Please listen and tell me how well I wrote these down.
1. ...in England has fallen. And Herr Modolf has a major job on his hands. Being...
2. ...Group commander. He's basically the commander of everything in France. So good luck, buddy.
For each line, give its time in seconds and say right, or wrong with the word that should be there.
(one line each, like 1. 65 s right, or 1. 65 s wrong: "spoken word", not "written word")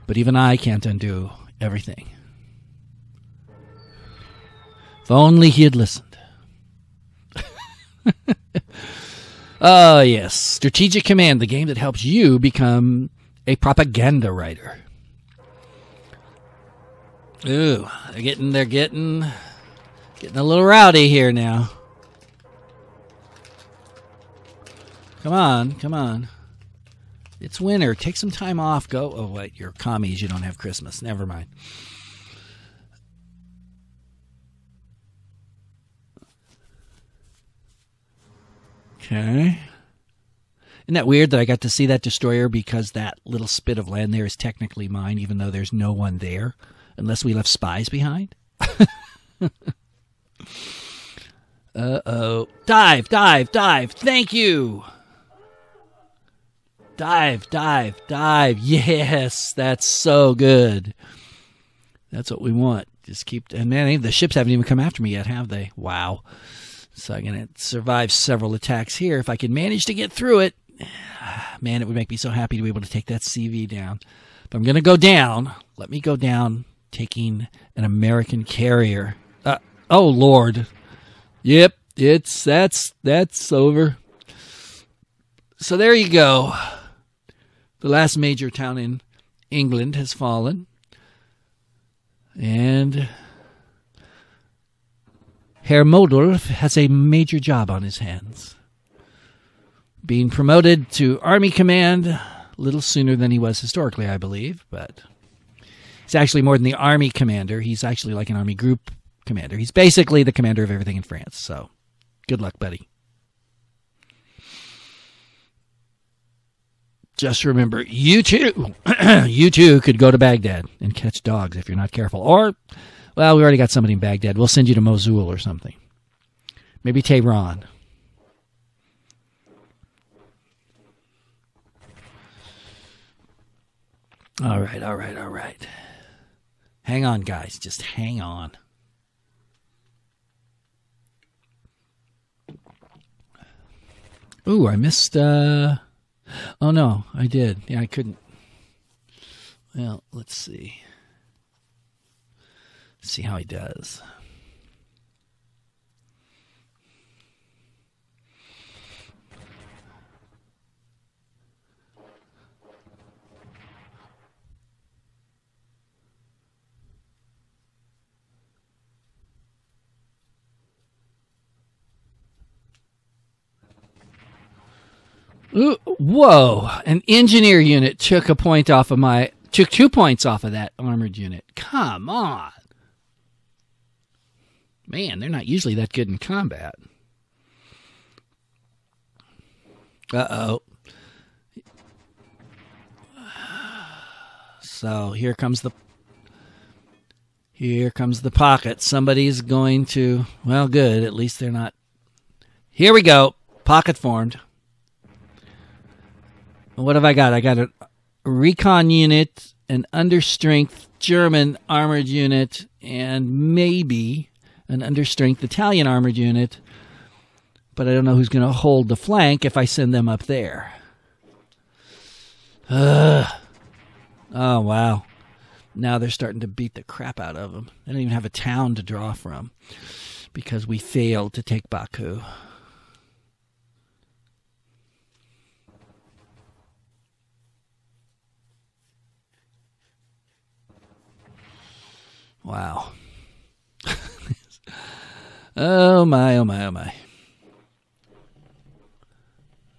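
1. 88 s right
2. 108 s right.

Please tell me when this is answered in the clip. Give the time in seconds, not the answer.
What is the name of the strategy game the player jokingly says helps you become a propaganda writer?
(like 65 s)
10 s.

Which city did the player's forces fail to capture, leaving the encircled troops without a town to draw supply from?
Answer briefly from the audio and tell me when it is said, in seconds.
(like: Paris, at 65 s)
Baku, at 231 s.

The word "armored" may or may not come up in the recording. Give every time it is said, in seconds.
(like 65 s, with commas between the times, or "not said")
180 s, 211 s, 215 s.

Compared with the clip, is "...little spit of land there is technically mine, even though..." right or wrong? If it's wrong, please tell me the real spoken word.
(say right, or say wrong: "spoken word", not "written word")
right.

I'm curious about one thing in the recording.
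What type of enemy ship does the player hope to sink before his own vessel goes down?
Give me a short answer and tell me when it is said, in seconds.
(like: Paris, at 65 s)
American carrier, at 77 s.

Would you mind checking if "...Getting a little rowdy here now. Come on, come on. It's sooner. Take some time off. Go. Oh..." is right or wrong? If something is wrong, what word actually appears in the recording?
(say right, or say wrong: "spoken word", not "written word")
wrong: "winter", not "sooner".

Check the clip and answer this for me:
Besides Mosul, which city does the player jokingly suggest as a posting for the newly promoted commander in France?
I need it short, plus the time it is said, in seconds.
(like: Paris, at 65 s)
Tehran, at 127 s.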